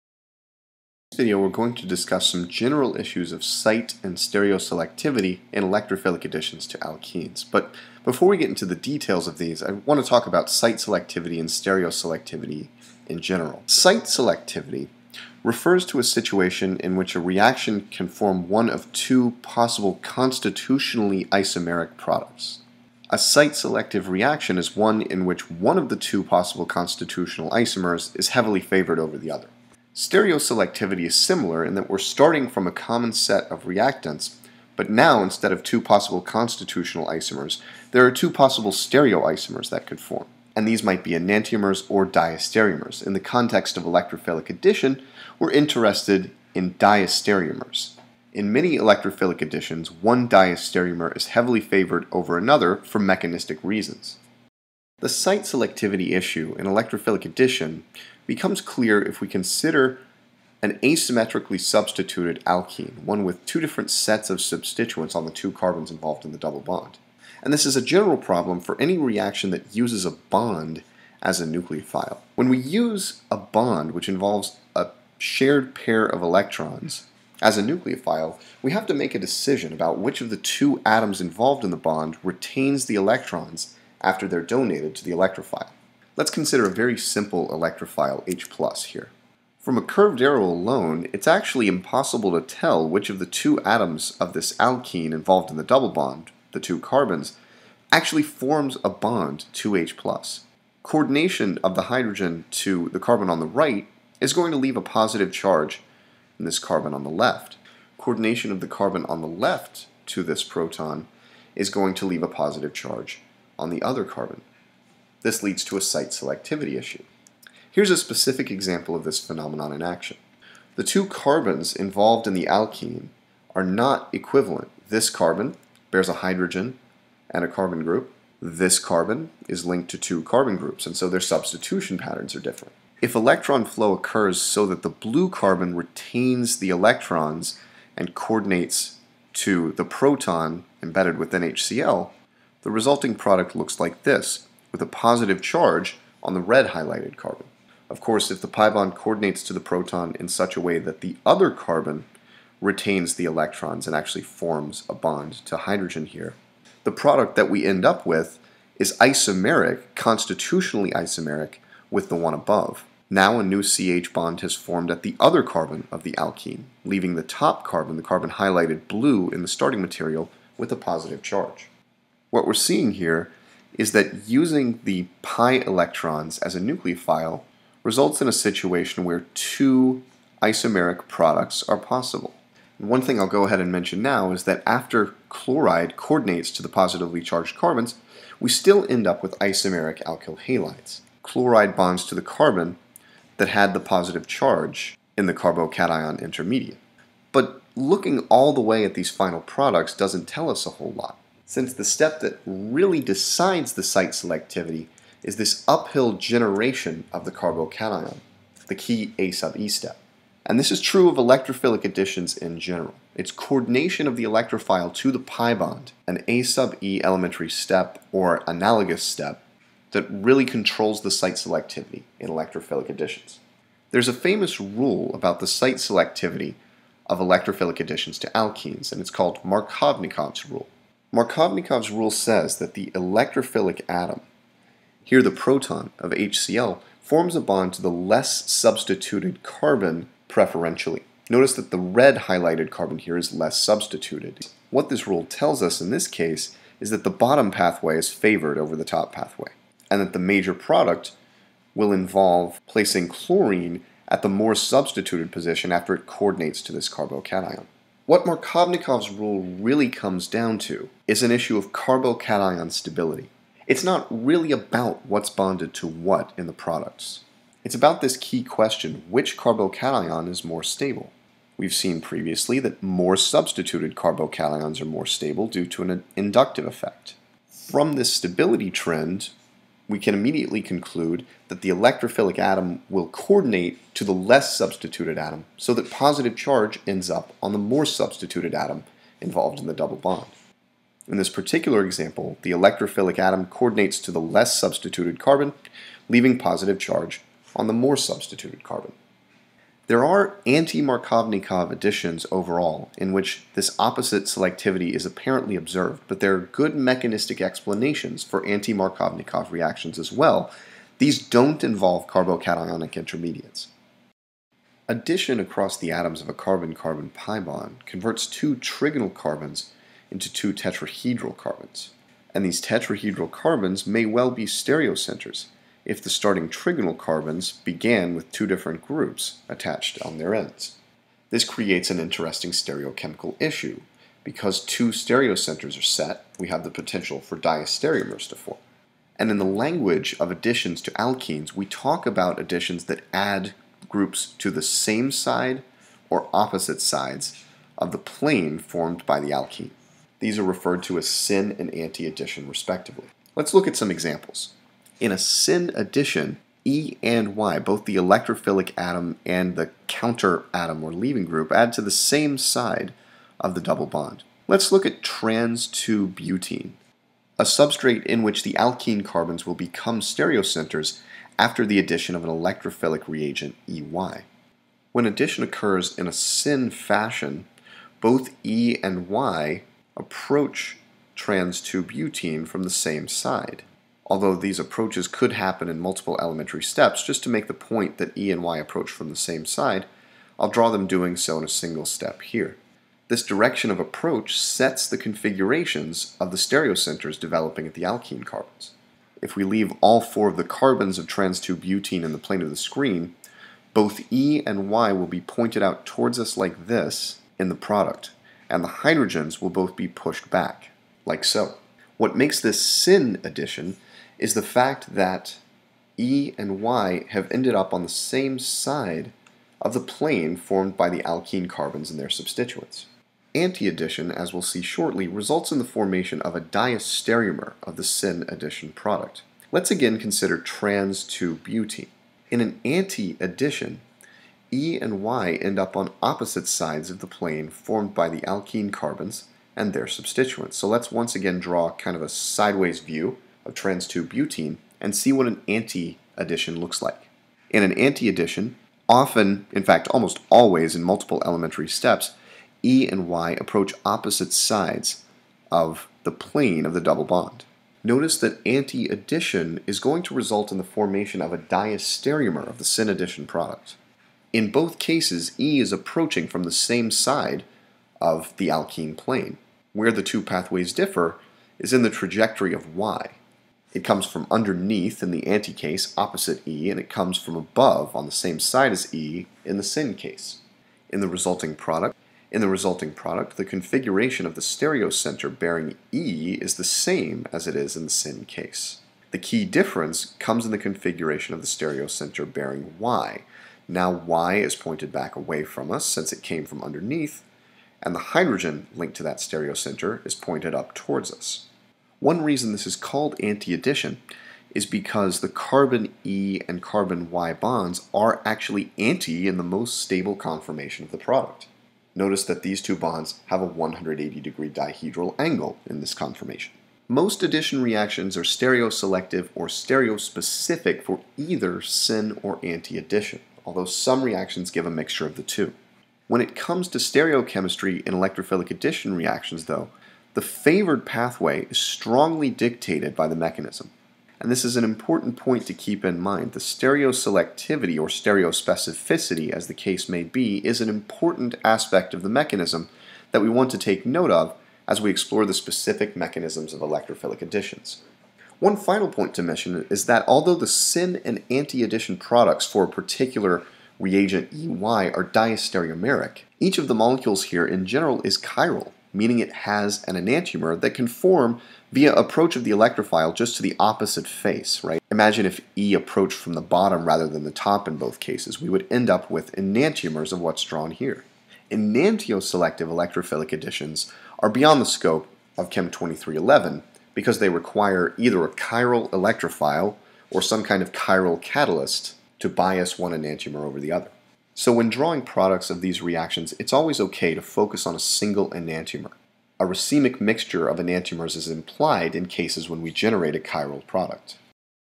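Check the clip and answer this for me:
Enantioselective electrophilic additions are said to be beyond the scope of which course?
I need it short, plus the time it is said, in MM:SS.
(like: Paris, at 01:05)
Chem 2311, at 09:35.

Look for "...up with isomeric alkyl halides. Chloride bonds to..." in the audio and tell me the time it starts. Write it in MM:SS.
03:09.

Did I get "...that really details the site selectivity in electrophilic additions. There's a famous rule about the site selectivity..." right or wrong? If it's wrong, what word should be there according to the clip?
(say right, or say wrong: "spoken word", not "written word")
wrong: "controls", not "details".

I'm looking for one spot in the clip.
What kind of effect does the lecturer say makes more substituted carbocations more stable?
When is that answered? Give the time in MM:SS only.
04:36.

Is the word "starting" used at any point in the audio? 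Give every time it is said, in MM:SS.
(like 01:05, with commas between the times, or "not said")
00:31, 02:49, 05:26.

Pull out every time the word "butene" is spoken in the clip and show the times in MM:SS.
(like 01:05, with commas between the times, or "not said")
06:06, 06:21, 06:41, 07:11, 07:24.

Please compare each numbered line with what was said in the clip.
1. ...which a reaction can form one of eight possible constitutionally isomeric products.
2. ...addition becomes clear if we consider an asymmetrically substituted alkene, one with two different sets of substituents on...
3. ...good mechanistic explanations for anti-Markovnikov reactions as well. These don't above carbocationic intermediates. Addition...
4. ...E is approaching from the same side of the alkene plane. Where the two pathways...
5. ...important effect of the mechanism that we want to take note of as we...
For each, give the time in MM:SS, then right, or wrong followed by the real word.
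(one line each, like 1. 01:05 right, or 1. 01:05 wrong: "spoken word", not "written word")
1. 00:16 wrong: "two", not "eight"
2. 00:57 right
3. 05:06 wrong: "involve", not "above"
4. 07:45 right
5. 09:00 wrong: "aspect", not "effect".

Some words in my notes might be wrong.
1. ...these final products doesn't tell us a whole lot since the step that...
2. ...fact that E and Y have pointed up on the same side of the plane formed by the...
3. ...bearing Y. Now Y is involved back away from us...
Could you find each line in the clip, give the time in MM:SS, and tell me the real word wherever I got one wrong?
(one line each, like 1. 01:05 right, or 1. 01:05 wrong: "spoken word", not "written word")
1. 03:18 right
2. 06:54 wrong: "ended", not "pointed"
3. 08:12 wrong: "pointed", not "involved".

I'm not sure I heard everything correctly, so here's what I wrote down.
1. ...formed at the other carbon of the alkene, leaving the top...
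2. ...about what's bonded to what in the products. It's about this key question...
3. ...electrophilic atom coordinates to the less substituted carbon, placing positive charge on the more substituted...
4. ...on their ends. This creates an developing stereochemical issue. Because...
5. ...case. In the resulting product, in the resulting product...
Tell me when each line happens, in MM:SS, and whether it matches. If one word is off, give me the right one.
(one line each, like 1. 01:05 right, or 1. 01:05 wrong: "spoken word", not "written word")
1. 02:44 right
2. 04:24 right
3. 04:52 wrong: "leaving", not "placing"
4. 05:30 wrong: "interesting", not "developing"
5. 07:59 right.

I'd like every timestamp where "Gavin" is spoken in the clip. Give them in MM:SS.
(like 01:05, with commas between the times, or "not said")
not said.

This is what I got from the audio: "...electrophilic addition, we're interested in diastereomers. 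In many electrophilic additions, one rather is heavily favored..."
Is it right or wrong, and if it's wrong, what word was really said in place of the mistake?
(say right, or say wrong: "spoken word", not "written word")
wrong: "diastereomer", not "rather".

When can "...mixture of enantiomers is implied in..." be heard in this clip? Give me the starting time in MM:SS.
09:50.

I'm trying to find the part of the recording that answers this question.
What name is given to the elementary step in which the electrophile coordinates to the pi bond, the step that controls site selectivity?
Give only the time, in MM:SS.
03:29.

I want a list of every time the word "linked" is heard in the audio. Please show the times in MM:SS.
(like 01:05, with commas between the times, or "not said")
02:09, 08:18.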